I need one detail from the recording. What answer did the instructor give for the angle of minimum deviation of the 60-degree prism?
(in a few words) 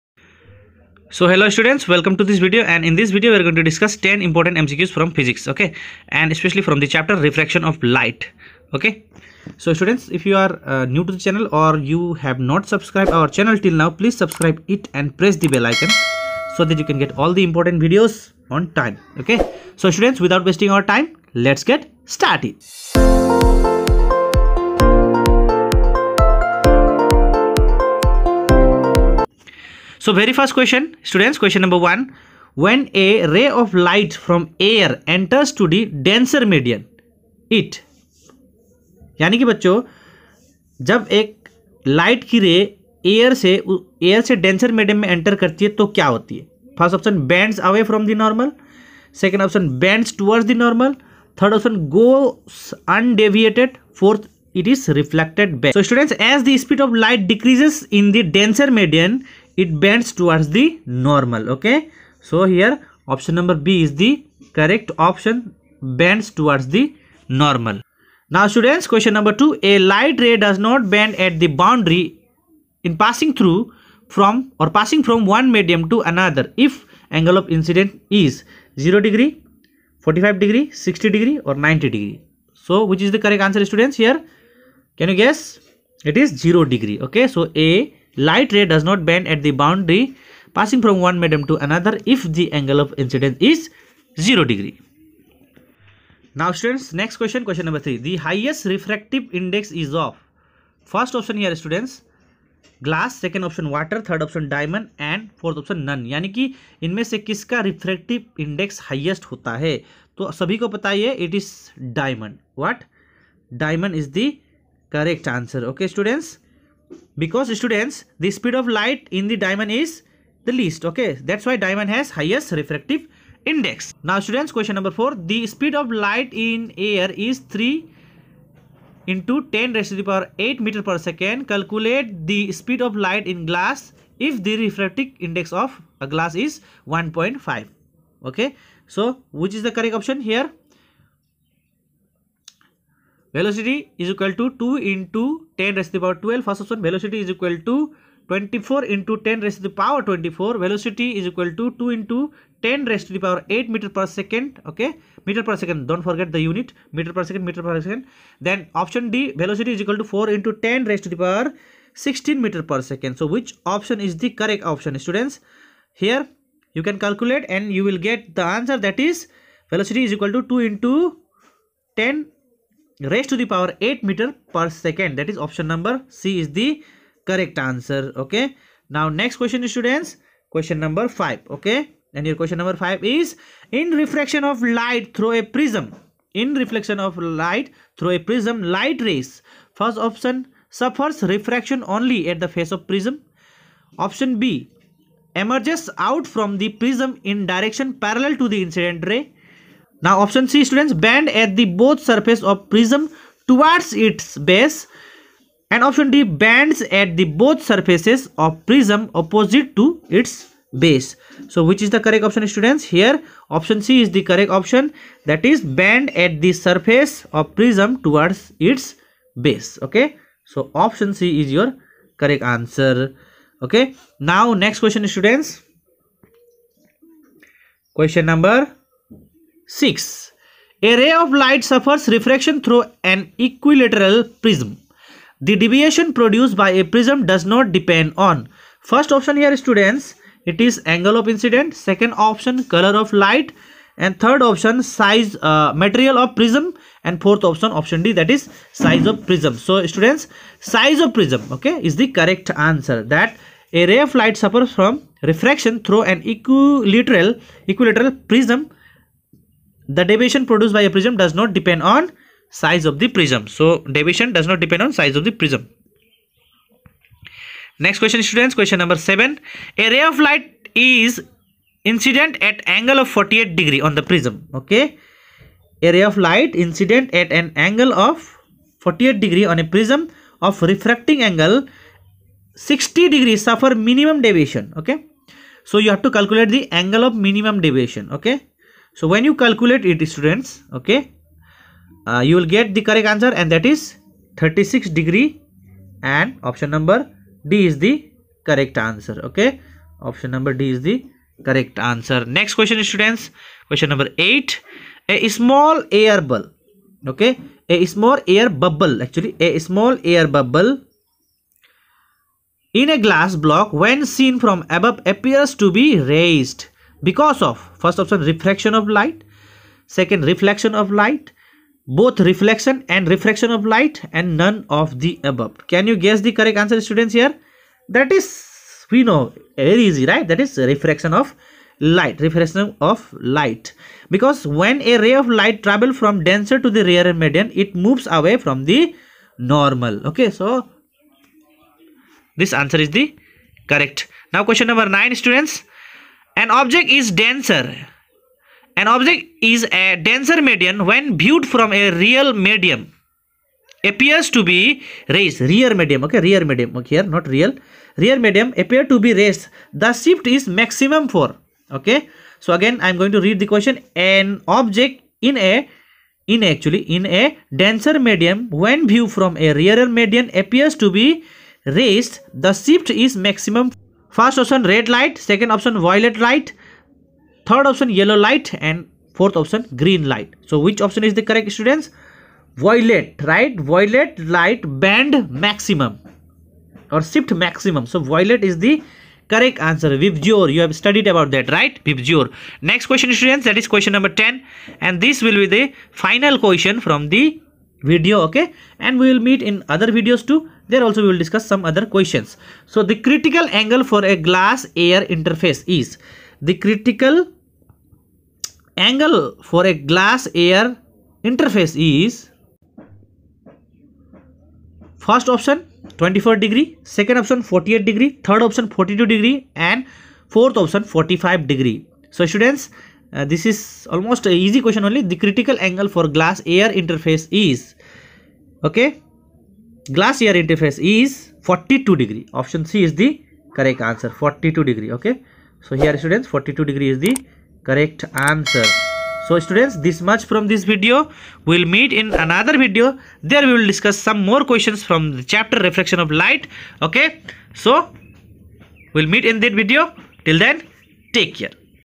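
36 degrees.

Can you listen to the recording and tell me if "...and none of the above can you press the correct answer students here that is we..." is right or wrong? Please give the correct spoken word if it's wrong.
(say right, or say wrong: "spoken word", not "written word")
wrong: "guess", not "press".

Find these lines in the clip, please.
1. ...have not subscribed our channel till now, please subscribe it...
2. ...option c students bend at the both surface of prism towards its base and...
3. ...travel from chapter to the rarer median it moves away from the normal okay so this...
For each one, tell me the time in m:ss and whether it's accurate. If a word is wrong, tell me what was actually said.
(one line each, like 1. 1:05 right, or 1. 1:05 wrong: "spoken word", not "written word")
1. 0:12 right
2. 3:20 right
3. 5:35 wrong: "denser", not "chapter".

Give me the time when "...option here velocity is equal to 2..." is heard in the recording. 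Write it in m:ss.
2:20.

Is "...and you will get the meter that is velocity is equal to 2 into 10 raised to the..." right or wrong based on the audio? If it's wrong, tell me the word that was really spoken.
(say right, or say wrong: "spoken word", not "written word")
wrong: "answer", not "meter".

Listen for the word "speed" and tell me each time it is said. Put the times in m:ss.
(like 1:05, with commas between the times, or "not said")
1:58, 2:05, 2:12.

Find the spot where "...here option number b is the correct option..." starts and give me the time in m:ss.
1:02.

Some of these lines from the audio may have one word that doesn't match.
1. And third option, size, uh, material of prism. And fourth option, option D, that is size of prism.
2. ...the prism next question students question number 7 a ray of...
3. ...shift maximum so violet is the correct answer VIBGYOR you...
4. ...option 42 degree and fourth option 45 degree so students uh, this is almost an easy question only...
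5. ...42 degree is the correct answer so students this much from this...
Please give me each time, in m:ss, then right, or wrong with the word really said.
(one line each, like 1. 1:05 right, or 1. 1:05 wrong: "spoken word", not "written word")
1. 4:03 right
2. 4:25 right
3. 6:27 right
4. 6:58 right
5. 7:16 right.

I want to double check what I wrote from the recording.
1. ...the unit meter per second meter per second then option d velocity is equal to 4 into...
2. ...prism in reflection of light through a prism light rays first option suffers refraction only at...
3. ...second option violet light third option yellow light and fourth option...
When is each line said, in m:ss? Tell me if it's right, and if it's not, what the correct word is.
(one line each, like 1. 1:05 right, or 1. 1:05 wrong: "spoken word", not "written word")
1. 2:36 right
2. 3:05 right
3. 6:15 right.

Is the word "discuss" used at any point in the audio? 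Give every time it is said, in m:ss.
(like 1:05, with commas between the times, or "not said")
0:03, 6:41, 7:23.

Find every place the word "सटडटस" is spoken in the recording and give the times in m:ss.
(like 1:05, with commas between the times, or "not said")
0:31, 0:55, 1:55.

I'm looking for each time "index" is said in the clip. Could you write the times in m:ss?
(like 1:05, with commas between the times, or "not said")
1:39, 2:03, 2:15.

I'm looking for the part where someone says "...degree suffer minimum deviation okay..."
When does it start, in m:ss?
4:43.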